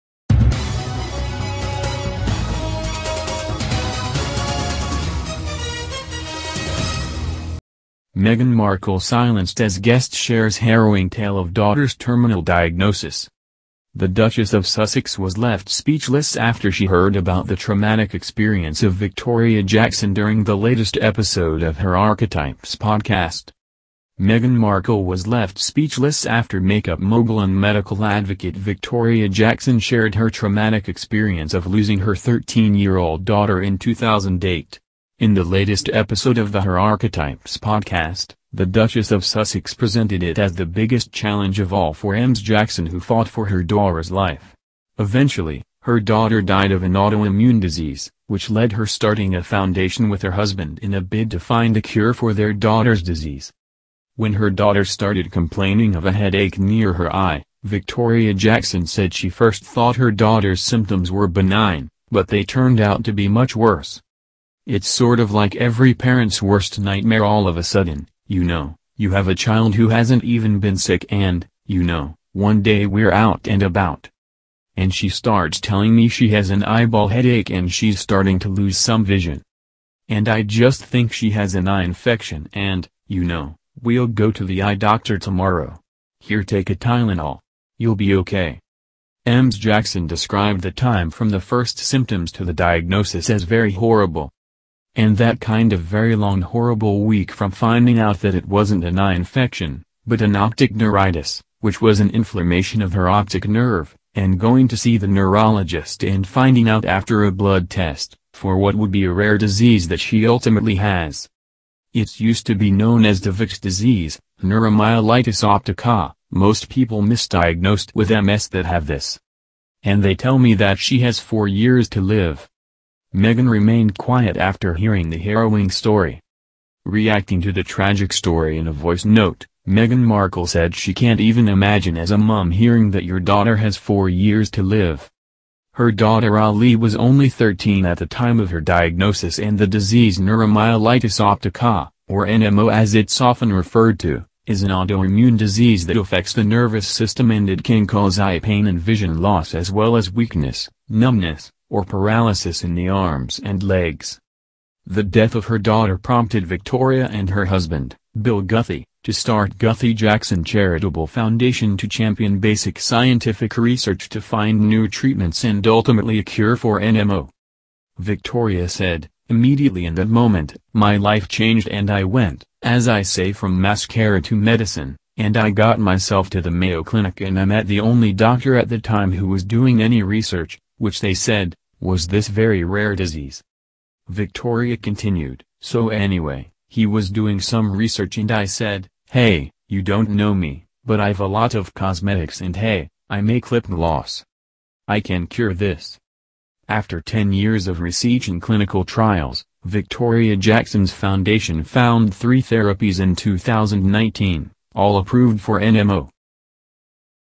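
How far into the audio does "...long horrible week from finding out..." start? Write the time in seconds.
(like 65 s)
96 s.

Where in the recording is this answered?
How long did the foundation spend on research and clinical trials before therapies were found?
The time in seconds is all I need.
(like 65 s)
197 s.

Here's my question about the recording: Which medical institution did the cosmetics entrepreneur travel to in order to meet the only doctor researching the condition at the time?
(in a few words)
Mayo Clinic.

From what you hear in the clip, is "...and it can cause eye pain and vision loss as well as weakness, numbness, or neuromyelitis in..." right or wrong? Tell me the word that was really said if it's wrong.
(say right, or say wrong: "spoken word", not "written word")
wrong: "paralysis", not "neuromyelitis".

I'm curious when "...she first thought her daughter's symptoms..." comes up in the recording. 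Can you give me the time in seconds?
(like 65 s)
59 s.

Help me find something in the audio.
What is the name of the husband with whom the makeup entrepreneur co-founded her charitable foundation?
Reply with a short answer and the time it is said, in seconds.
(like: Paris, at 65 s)
Bill Guthy, at 158 s.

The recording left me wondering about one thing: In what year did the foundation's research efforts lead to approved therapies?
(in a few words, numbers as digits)
2019.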